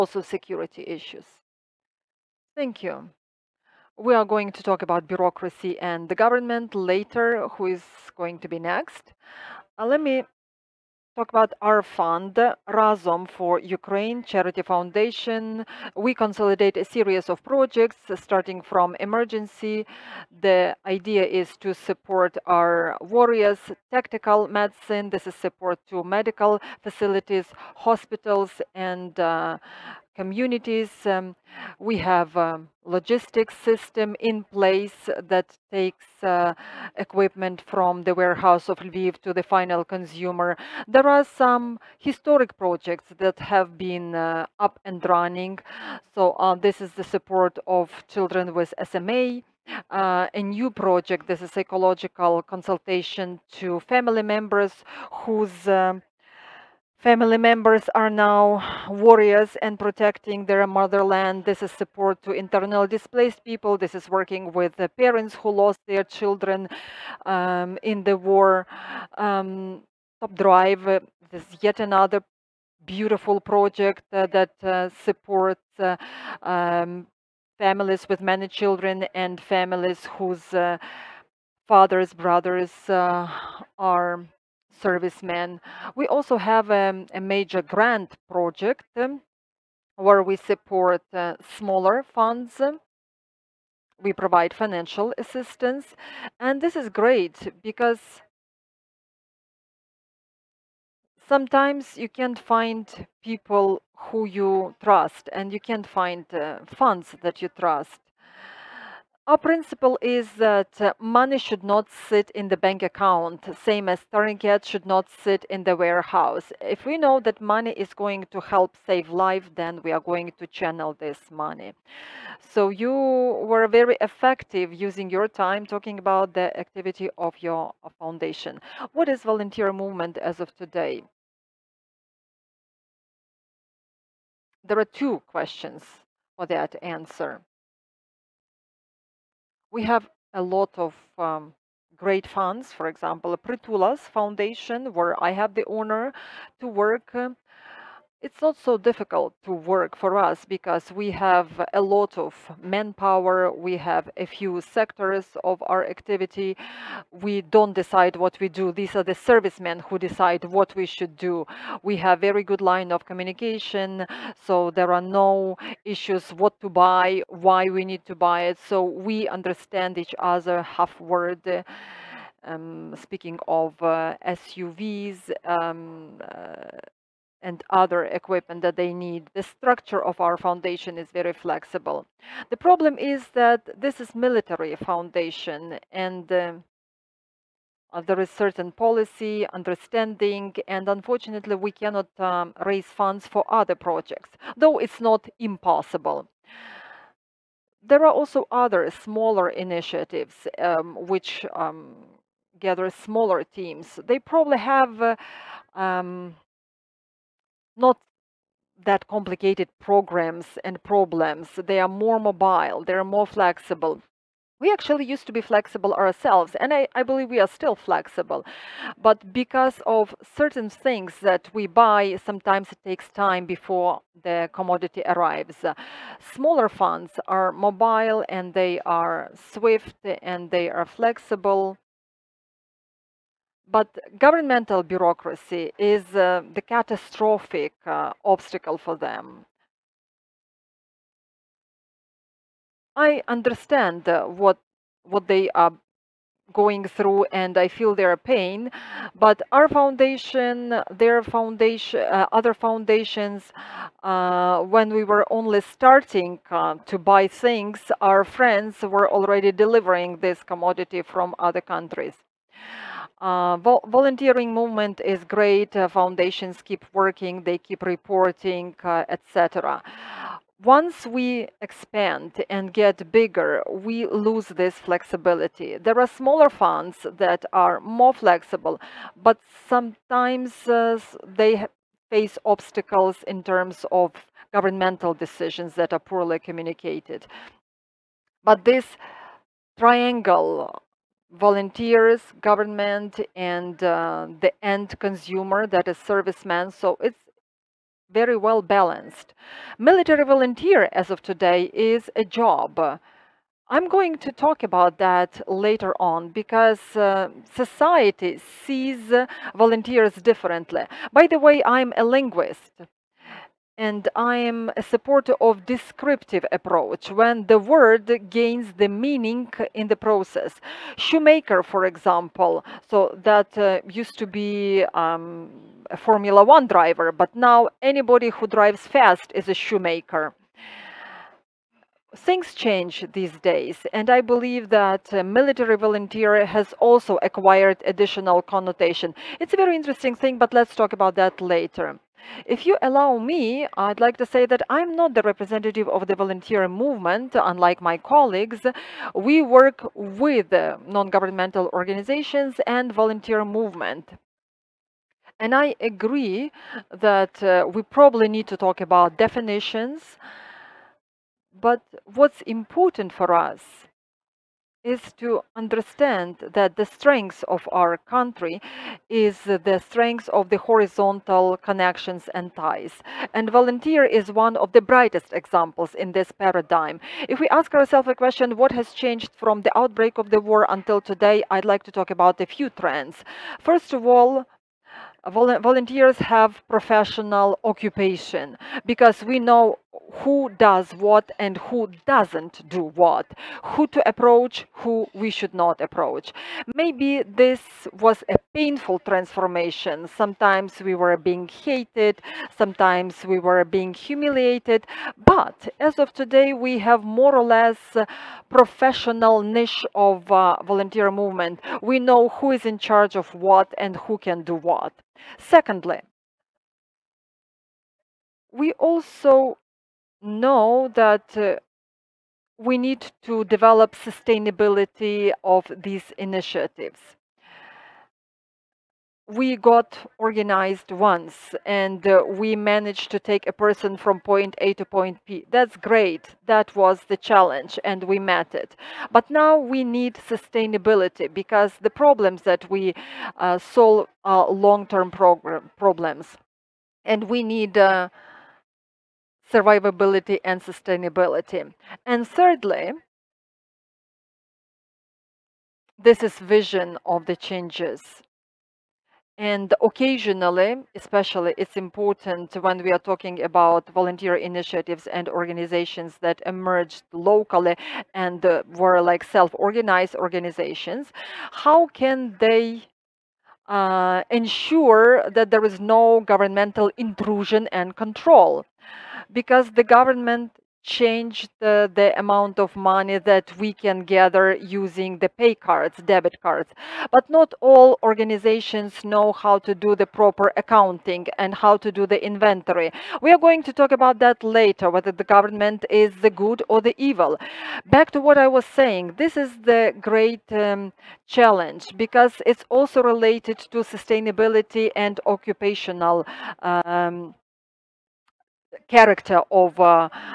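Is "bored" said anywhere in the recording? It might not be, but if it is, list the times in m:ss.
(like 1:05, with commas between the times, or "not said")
not said.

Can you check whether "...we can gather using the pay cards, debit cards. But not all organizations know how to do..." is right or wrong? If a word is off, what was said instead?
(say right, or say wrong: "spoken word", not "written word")
right.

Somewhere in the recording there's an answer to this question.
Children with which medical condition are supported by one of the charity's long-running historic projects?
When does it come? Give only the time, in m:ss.
0:48.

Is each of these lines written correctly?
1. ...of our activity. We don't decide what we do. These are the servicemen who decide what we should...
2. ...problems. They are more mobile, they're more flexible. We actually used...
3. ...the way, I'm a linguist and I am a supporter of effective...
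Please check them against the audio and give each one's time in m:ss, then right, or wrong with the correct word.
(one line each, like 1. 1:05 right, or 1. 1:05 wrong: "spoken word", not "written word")
1. 2:35 right
2. 3:30 right
3. 5:11 wrong: "descriptive", not "effective".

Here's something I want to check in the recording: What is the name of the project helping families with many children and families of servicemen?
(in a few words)
Top Drive.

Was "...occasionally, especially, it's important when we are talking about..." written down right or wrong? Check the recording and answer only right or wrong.
right.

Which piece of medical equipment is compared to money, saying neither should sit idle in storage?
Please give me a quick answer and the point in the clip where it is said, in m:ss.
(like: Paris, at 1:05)
tourniquet, at 1:54.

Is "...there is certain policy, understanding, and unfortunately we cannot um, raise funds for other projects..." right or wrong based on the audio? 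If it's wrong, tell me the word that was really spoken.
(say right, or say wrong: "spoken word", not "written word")
right.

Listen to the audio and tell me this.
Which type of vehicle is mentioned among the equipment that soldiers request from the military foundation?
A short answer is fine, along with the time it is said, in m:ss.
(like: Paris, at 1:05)
SUVs, at 2:54.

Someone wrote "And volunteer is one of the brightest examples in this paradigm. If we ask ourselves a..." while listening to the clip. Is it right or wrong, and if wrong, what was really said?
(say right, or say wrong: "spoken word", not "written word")
right.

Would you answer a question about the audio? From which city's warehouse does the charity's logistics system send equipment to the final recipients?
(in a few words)
Lviv.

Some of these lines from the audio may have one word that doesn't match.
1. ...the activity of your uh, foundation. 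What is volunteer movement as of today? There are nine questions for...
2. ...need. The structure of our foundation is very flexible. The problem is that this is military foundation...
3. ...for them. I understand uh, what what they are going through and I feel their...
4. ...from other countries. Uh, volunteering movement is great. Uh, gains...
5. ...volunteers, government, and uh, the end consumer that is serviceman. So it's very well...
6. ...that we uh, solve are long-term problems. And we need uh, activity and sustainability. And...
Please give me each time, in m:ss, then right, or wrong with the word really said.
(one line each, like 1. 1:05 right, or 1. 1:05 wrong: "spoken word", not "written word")
1. 2:06 wrong: "two", not "nine"
2. 2:59 right
3. 3:58 right
4. 4:21 wrong: "foundations", not "gains"
5. 4:51 right
6. 7:22 wrong: "survivability", not "activity".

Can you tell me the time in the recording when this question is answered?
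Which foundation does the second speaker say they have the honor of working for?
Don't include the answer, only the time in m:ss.
2:23.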